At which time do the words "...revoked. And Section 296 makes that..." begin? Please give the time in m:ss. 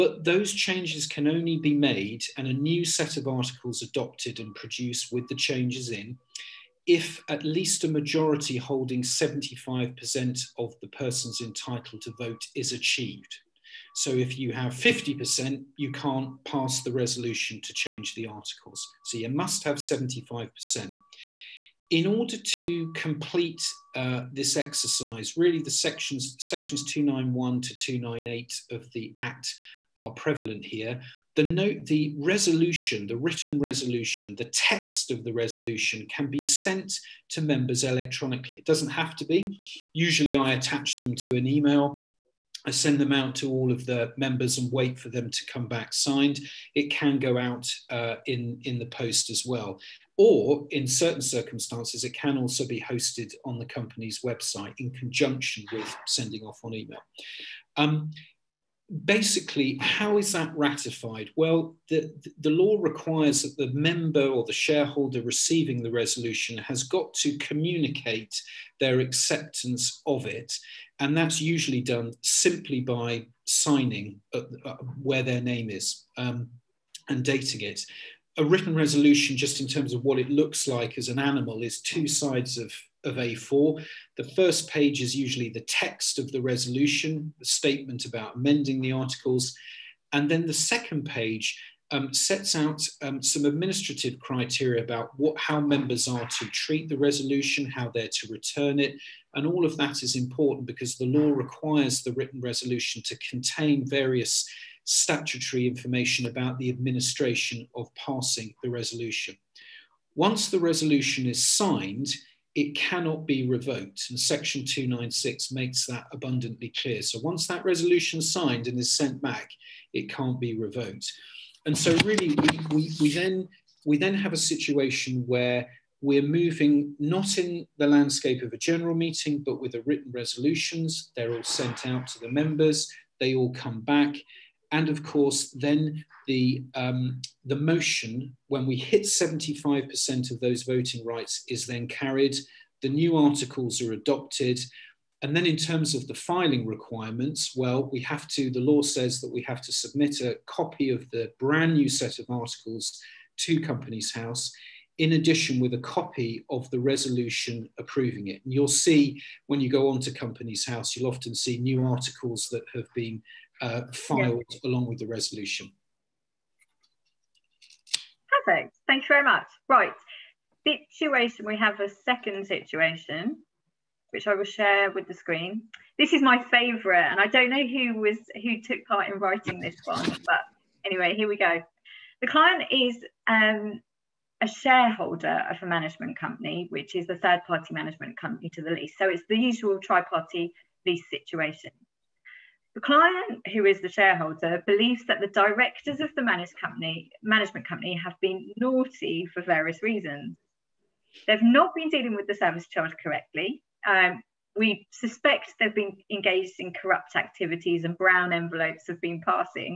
1:53.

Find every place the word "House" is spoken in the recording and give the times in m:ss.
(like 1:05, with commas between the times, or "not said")
2:34, 2:40.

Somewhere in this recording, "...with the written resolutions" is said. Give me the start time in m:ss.
2:09.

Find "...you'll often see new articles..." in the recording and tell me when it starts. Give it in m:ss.
2:40.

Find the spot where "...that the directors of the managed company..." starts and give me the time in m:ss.
3:15.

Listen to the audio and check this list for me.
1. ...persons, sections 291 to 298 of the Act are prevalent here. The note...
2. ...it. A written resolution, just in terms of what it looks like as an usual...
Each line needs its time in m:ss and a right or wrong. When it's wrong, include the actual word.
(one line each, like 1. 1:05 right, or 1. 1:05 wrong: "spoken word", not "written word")
1. 0:25 wrong: "sections", not "persons"
2. 1:17 wrong: "animal", not "usual".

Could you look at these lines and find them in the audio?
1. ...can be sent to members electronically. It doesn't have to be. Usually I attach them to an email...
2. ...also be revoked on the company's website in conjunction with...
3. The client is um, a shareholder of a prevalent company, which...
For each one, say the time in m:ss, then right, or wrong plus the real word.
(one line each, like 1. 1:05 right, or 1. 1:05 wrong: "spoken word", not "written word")
1. 0:36 right
2. 0:52 wrong: "hosted", not "revoked"
3. 3:02 wrong: "management", not "prevalent".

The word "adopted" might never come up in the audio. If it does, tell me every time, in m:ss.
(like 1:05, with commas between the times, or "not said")
0:03, 2:23.